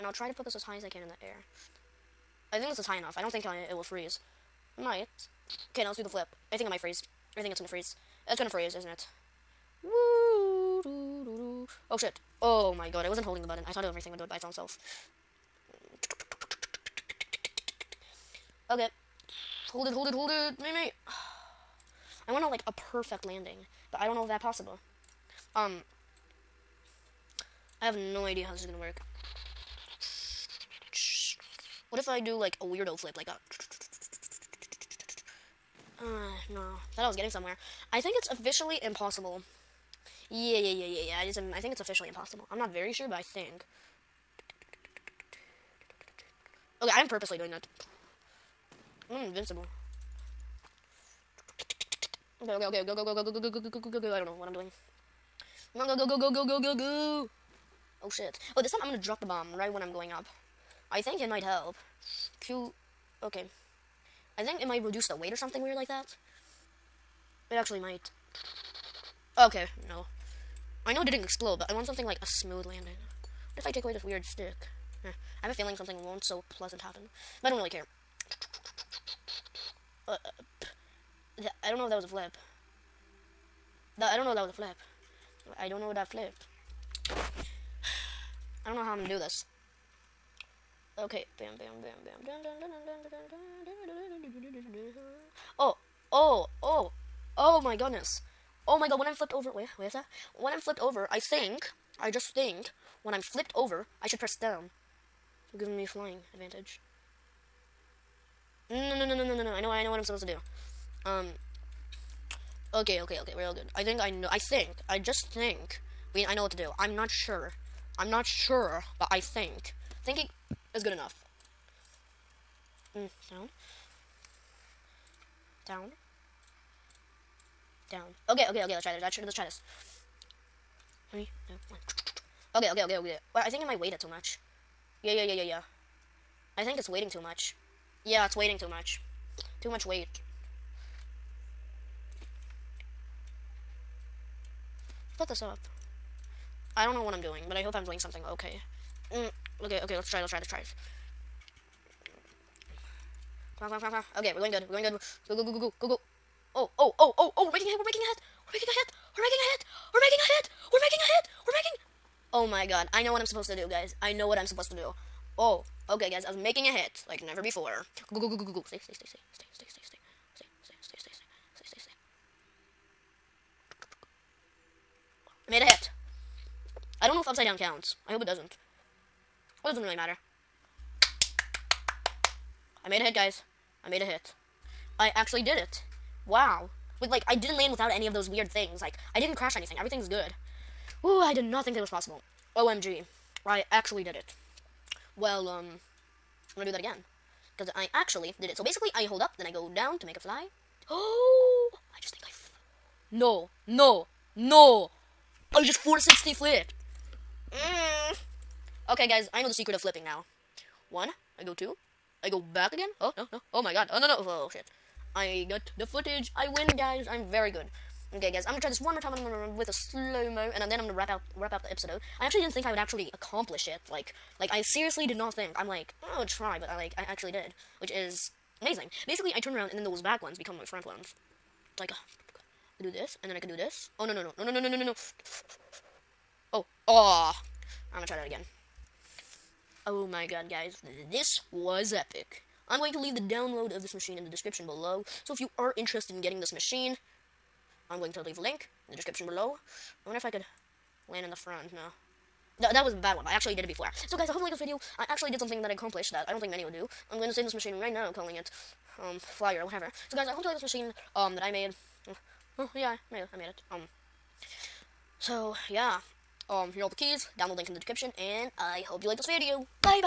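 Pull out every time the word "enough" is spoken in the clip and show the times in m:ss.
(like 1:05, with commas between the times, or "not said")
0:02, 2:00.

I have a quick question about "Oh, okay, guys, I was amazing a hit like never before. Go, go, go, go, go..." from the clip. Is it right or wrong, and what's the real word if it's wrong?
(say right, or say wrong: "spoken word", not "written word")
wrong: "making", not "amazing".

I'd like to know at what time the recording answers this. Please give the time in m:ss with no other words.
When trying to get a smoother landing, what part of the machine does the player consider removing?
1:14.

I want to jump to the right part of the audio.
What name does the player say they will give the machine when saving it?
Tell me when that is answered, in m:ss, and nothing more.
4:19.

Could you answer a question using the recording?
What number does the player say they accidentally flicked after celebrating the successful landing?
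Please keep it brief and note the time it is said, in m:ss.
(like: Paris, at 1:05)
460, at 3:25.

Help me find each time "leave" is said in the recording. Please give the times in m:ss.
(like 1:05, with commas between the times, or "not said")
4:02, 4:08.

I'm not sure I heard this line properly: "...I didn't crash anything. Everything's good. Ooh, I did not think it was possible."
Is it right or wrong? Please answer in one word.
right.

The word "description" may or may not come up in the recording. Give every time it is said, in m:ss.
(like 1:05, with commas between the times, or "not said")
4:04, 4:08, 4:27.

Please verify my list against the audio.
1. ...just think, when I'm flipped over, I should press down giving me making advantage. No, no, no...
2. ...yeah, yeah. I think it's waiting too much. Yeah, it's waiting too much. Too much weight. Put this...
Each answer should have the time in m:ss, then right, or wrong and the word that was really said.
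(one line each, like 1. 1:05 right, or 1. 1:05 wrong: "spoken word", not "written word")
1. 1:42 wrong: "flying", not "making"
2. 2:15 right.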